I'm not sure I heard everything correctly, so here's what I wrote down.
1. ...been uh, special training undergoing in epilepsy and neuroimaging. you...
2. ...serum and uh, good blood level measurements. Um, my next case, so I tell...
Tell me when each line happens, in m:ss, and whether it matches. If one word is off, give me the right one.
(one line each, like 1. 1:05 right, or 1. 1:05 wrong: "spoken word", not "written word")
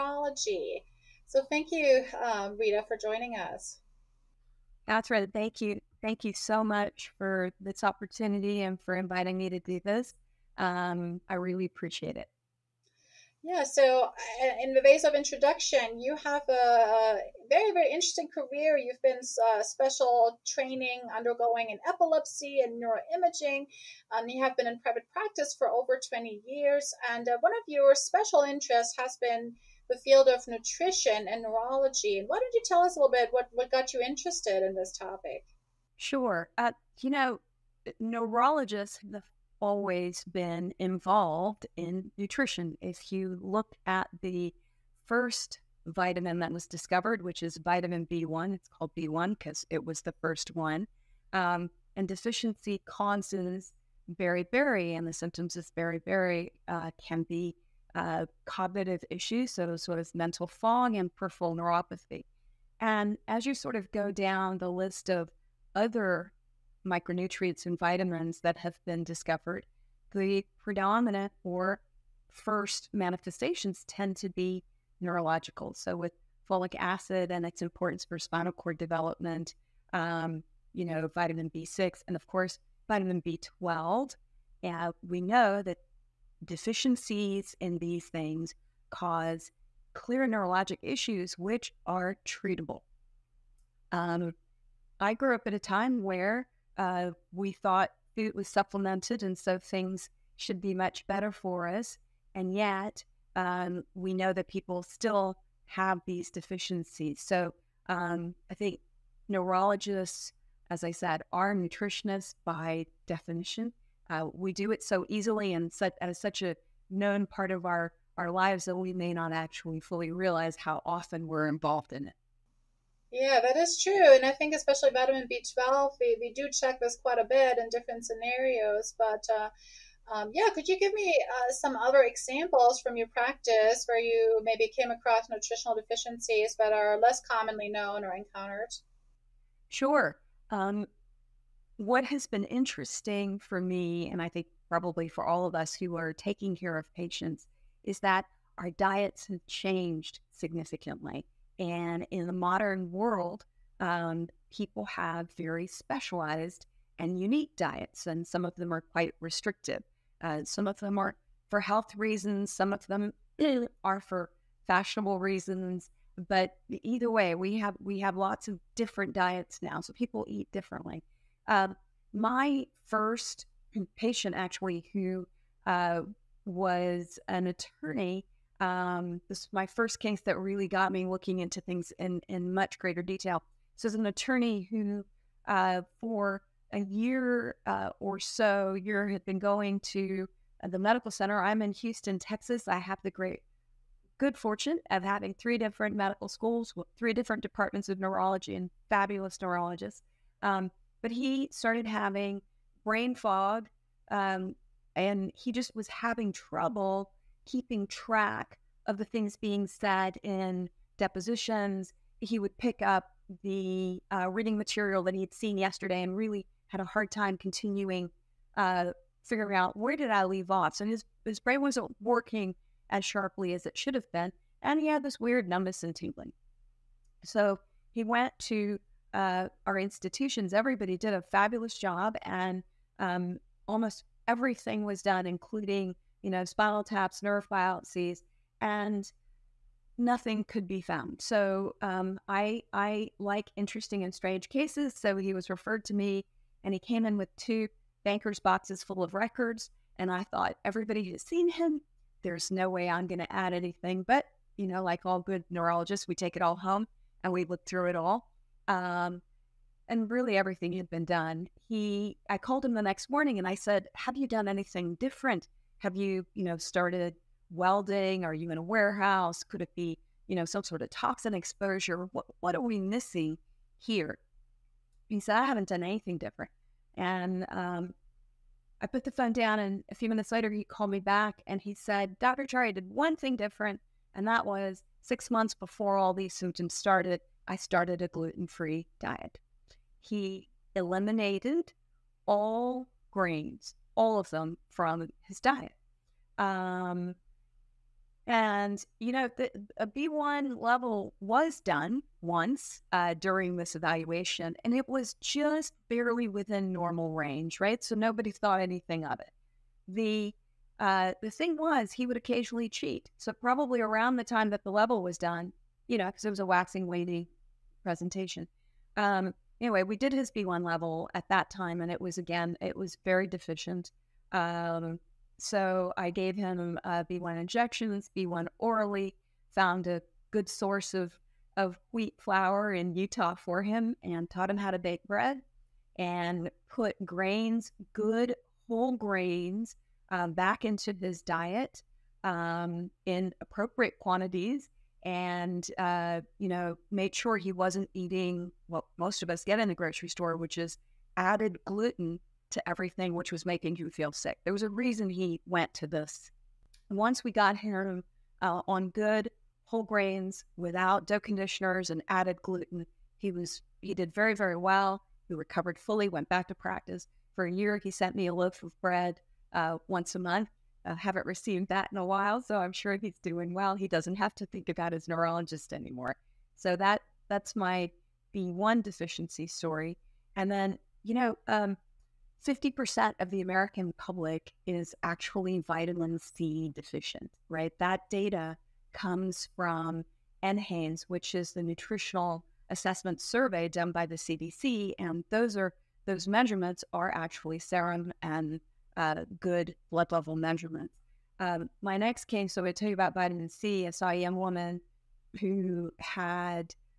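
1. 0:19 right
2. 6:37 right.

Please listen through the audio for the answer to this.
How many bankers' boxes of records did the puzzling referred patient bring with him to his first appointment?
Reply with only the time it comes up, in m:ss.
4:07.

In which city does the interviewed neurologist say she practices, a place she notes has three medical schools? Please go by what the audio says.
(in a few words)
Houston.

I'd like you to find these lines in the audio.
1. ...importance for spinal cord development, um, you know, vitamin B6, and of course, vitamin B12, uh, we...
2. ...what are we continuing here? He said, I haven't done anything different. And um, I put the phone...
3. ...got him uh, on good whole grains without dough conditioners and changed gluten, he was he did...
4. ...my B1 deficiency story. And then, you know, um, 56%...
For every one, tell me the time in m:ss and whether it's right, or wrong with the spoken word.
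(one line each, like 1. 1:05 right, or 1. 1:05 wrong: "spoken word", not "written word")
1. 1:17 right
2. 4:32 wrong: "missing", not "continuing"
3. 5:57 wrong: "added", not "changed"
4. 6:17 wrong: "50", not "56".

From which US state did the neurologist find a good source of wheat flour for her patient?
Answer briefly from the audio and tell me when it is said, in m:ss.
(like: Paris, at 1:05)
Utah, at 5:32.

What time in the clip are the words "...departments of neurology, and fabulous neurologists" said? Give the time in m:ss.
3:17.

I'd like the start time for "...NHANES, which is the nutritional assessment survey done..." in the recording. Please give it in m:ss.
6:30.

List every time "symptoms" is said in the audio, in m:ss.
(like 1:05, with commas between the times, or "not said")
0:55, 4:46.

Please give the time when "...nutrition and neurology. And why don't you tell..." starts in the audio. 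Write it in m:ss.
0:30.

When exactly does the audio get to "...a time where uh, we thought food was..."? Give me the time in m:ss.
1:35.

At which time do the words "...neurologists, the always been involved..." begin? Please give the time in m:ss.
0:38.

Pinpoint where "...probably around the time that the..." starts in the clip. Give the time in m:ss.
5:13.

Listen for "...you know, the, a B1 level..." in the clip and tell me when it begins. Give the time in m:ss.
4:58.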